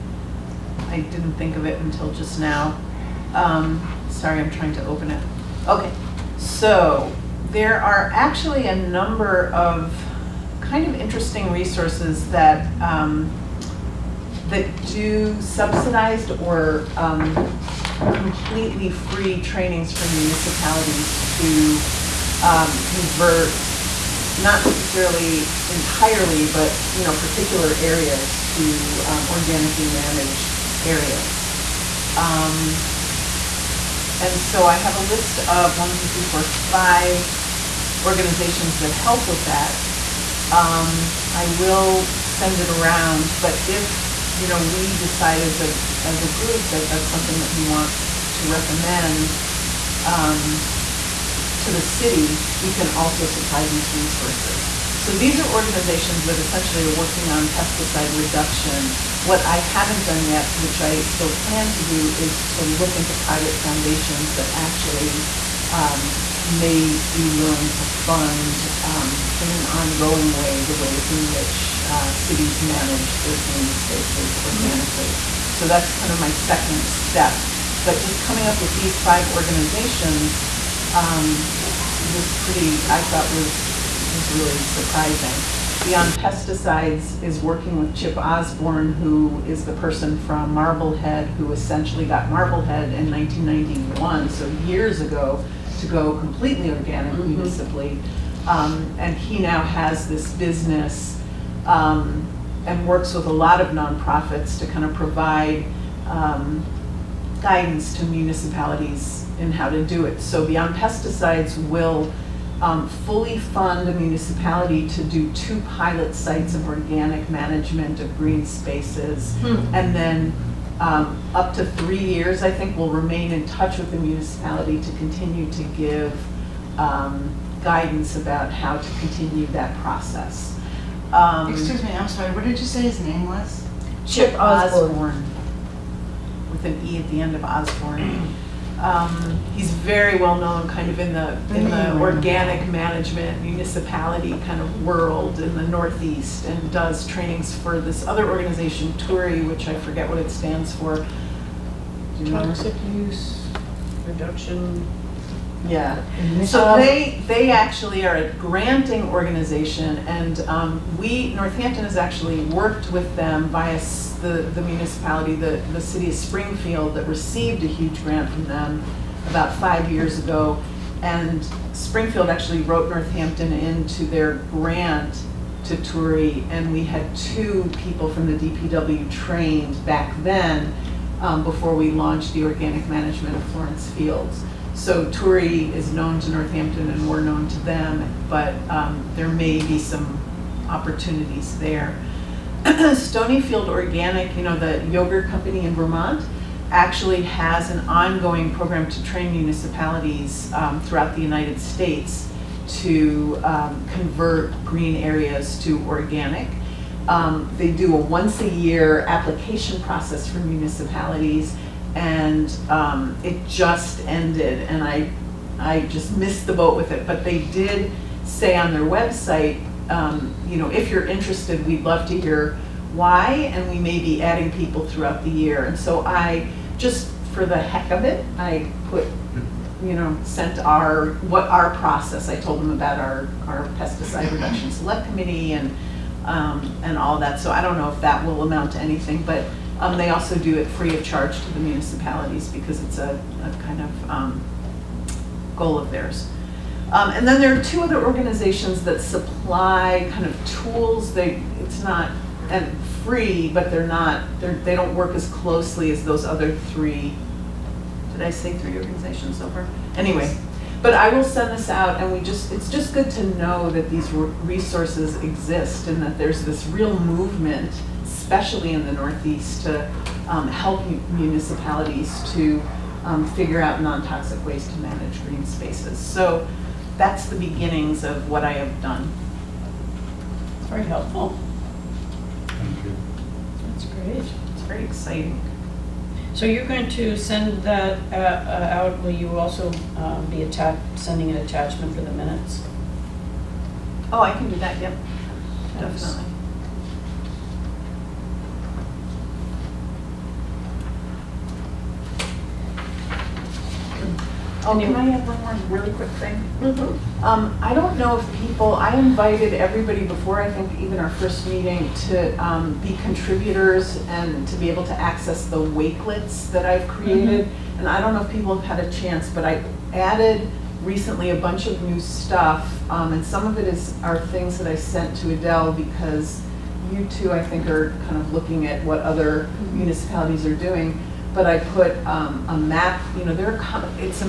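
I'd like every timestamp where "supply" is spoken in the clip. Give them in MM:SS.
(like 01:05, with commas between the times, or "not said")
00:53, 04:09.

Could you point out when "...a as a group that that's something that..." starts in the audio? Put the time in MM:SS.
00:45.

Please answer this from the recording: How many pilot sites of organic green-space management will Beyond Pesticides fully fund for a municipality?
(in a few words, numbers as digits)
2.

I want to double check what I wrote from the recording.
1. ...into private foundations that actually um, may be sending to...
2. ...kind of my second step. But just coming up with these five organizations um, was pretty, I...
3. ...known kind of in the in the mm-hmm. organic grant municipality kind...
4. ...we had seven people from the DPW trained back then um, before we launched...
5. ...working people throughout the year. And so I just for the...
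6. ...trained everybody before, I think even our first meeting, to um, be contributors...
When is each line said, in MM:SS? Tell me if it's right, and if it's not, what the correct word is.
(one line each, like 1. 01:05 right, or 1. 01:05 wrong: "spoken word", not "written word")
1. 01:02 wrong: "willing", not "sending"
2. 01:16 right
3. 02:20 wrong: "management", not "grant"
4. 02:56 wrong: "two", not "seven"
5. 03:44 wrong: "adding", not "working"
6. 05:09 wrong: "invited", not "trained".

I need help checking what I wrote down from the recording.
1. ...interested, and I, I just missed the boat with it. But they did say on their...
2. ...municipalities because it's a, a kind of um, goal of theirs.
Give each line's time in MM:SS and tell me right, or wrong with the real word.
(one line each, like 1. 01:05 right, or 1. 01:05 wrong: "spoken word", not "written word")
1. 03:34 wrong: "ended", not "interested"
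2. 04:01 right.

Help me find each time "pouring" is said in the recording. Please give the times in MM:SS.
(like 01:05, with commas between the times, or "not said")
not said.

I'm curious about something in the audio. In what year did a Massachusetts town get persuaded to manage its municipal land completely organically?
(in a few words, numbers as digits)
1991.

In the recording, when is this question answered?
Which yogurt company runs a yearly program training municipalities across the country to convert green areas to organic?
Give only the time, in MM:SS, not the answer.
03:12.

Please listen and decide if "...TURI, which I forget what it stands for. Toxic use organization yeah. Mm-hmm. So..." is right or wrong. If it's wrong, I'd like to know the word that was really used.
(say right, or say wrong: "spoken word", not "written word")
wrong: "reduction", not "organization".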